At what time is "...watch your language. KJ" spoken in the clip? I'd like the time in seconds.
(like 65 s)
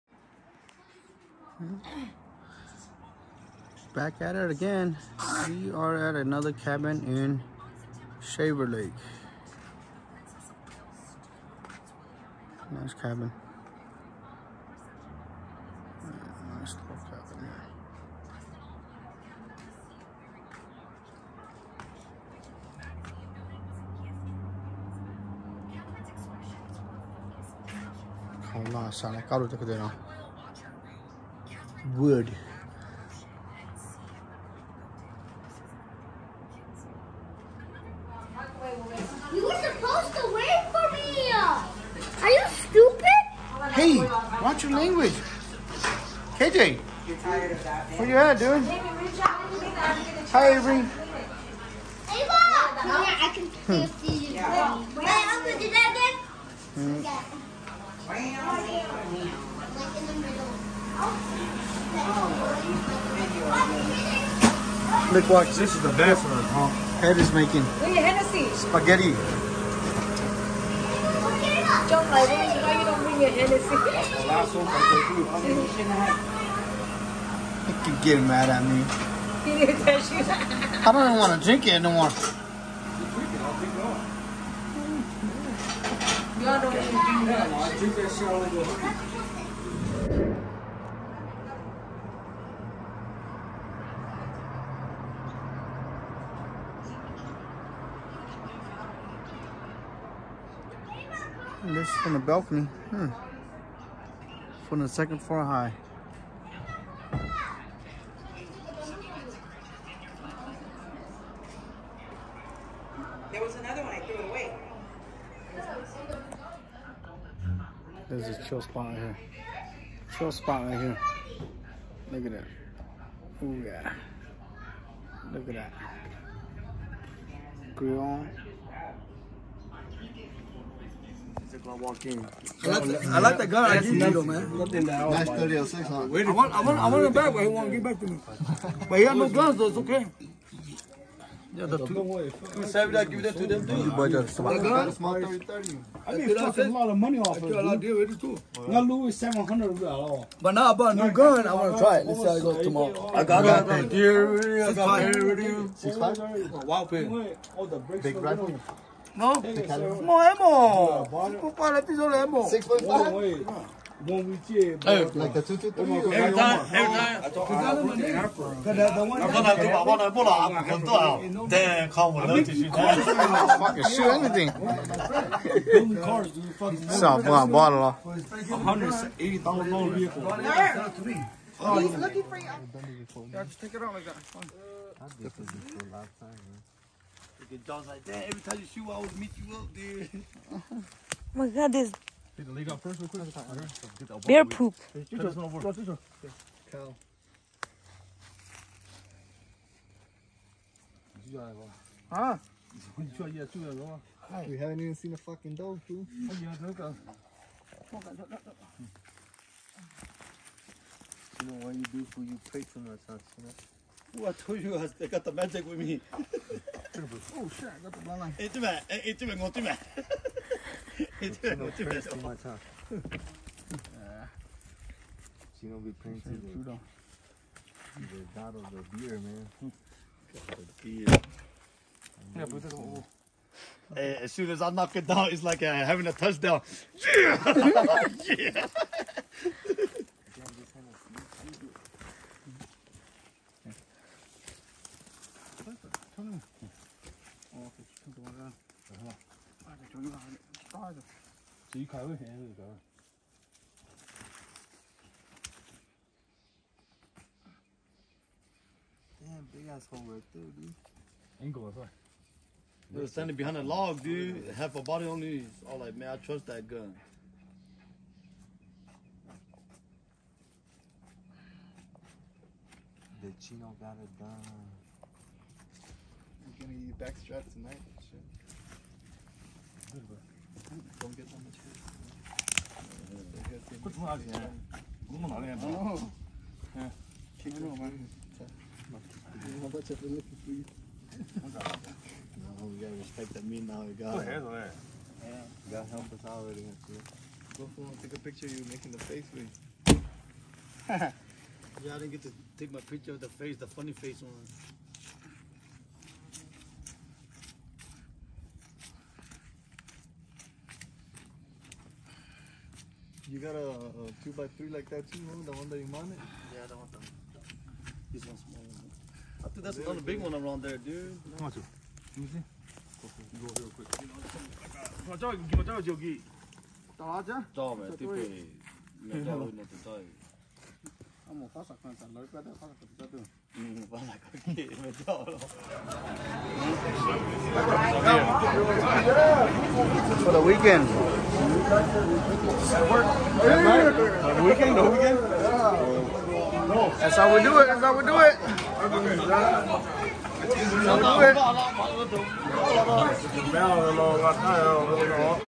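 44 s.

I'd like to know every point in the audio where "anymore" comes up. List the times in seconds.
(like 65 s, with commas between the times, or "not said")
81 s.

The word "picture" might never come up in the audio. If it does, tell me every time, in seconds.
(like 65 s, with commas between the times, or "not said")
298 s, 302 s.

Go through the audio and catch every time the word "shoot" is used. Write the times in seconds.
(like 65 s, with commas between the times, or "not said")
188 s.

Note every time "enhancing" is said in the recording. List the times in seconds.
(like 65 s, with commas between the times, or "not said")
not said.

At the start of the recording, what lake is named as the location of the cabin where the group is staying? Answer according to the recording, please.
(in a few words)
Shaver Lake.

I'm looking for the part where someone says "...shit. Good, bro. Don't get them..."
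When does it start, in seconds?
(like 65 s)
278 s.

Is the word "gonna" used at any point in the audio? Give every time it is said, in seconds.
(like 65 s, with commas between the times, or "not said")
225 s, 276 s.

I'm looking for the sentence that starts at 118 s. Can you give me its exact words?
There's a chill spot right here.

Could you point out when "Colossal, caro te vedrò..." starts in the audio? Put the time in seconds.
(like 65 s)
28 s.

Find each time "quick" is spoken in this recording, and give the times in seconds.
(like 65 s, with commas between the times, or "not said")
193 s, 323 s.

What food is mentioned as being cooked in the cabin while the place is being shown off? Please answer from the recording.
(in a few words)
spaghetti.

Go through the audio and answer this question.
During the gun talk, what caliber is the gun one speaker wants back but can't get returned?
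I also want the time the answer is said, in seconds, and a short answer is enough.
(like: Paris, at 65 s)
306, at 135 s.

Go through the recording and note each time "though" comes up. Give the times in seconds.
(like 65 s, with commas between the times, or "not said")
134 s, 139 s.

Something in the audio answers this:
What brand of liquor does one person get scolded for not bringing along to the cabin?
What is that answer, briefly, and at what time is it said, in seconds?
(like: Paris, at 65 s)
Hennessy, at 73 s.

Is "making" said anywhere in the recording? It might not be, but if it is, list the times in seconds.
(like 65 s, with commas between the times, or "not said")
67 s, 298 s.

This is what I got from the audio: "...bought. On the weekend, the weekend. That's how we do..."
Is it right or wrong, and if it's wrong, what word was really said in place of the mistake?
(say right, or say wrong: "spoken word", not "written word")
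wrong: "night", not "bought".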